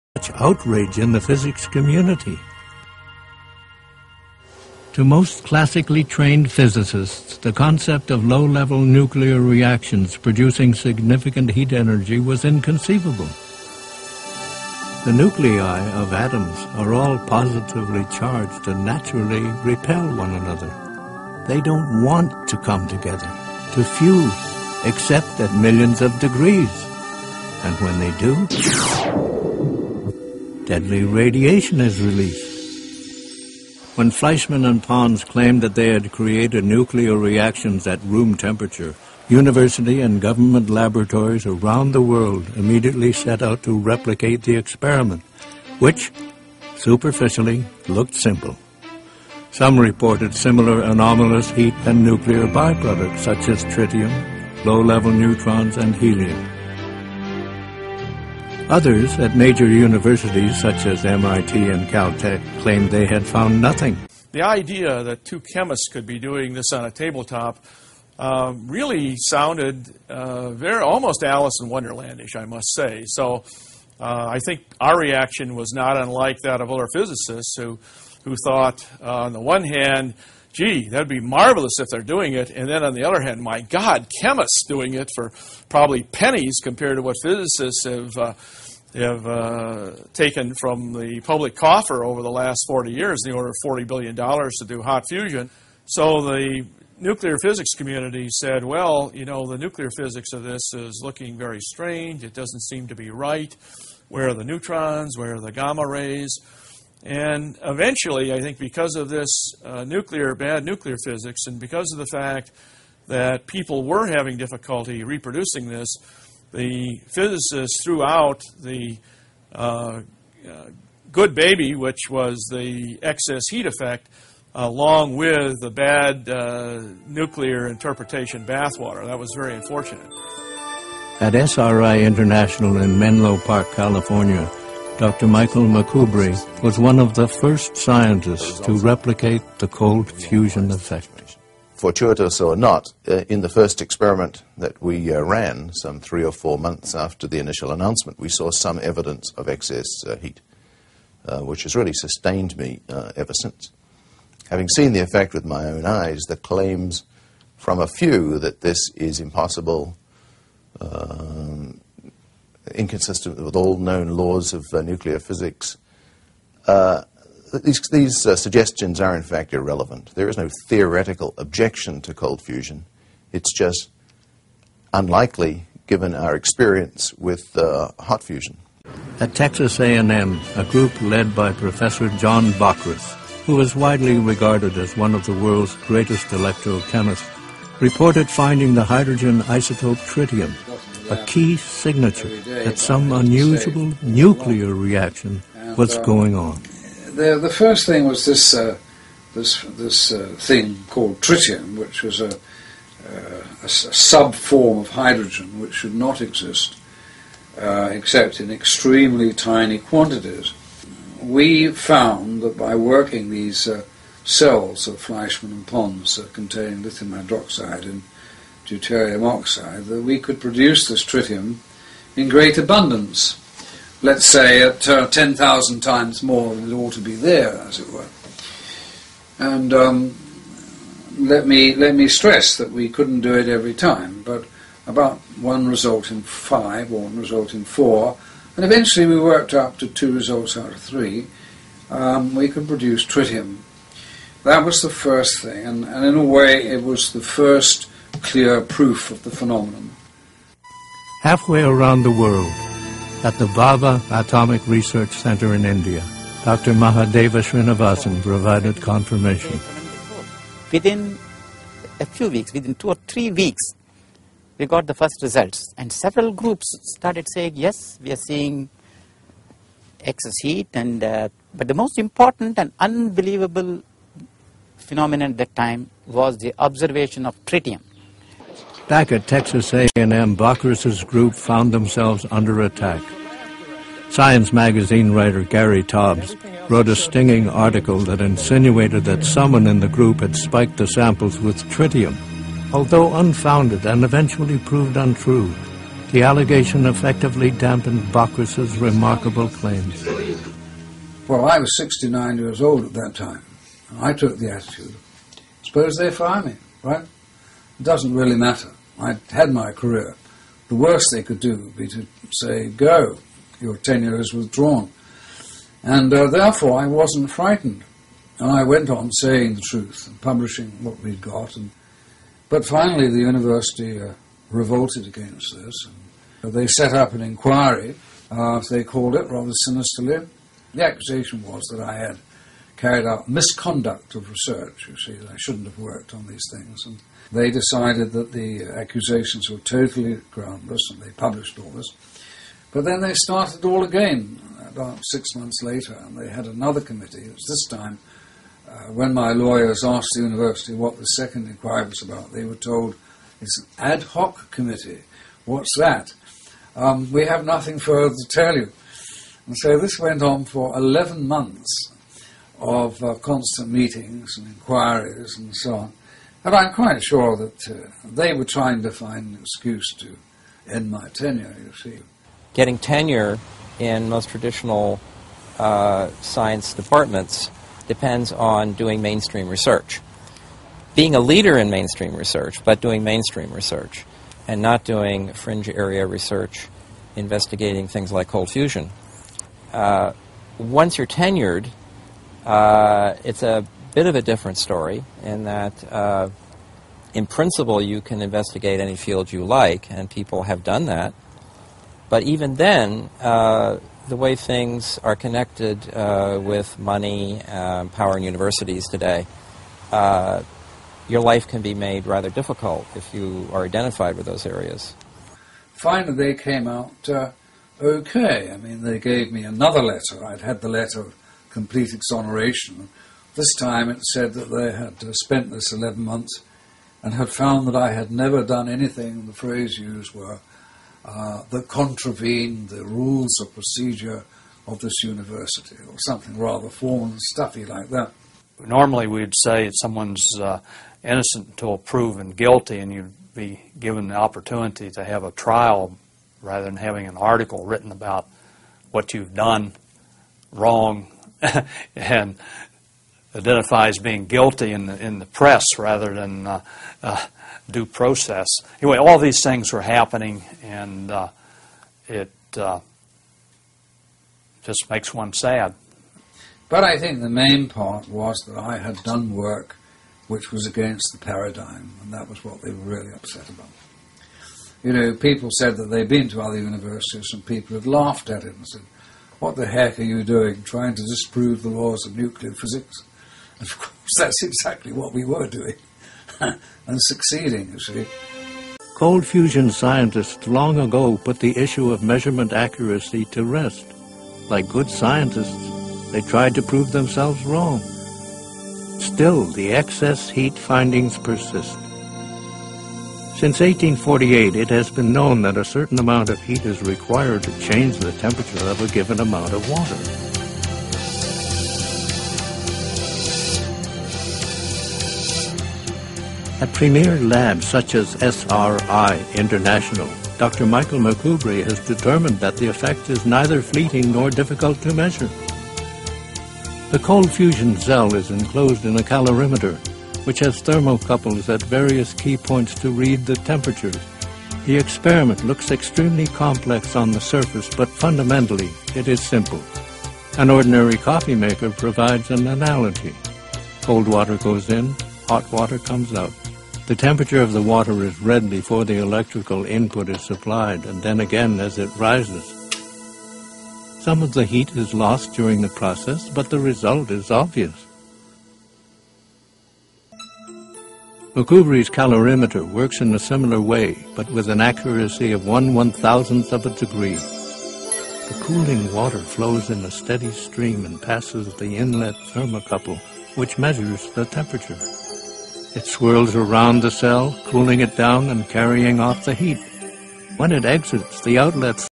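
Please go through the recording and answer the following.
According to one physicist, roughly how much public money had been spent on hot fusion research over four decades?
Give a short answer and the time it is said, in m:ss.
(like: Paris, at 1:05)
$40 billion, at 1:33.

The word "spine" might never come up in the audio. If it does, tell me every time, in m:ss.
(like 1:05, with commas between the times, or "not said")
not said.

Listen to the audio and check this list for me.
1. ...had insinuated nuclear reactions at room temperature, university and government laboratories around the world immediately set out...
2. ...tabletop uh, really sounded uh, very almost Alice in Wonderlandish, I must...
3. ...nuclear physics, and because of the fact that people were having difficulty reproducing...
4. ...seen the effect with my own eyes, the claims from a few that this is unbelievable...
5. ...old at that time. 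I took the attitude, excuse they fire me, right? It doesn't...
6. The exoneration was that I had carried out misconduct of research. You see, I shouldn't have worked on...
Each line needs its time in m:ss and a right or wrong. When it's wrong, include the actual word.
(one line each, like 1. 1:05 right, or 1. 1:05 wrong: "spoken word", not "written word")
1. 0:35 wrong: "created", not "insinuated"
2. 1:06 right
3. 1:50 right
4. 2:34 wrong: "impossible", not "unbelievable"
5. 5:02 wrong: "suppose", not "excuse"
6. 5:30 wrong: "accusation", not "exoneration".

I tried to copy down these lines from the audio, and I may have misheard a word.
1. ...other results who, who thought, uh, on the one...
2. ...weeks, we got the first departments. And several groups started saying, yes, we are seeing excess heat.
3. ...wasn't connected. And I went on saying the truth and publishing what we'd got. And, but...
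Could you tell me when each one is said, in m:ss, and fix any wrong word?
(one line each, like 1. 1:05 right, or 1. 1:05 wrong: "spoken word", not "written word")
1. 1:16 wrong: "physicists", not "results"
2. 4:23 wrong: "results", not "departments"
3. 5:16 wrong: "frightened", not "connected".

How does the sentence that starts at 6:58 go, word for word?
I mean, they gave me another letter.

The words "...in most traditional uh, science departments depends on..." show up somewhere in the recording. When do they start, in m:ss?
6:13.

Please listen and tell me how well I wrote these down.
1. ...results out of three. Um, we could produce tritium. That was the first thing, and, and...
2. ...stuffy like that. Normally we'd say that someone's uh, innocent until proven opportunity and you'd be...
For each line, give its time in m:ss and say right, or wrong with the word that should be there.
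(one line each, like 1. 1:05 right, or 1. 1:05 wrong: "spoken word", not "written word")
1. 4:00 right
2. 7:17 wrong: "guilty", not "opportunity".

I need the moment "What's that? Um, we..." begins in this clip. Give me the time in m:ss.
5:55.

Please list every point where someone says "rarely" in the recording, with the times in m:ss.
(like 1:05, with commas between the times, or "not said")
not said.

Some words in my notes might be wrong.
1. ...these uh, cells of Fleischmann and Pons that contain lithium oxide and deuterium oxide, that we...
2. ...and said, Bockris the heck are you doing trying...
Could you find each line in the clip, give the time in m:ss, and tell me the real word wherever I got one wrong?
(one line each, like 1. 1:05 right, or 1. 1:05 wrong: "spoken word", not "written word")
1. 3:33 wrong: "hydroxide", not "oxide"
2. 7:58 wrong: "What", not "Bockris".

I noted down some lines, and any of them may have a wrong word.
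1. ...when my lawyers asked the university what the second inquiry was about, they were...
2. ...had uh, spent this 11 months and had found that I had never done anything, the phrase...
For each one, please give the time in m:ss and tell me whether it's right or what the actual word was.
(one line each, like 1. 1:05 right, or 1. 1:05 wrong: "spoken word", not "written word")
1. 5:48 right
2. 7:04 right.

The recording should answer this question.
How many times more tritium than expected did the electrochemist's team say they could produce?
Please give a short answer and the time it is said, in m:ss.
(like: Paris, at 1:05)
10,000, at 3:45.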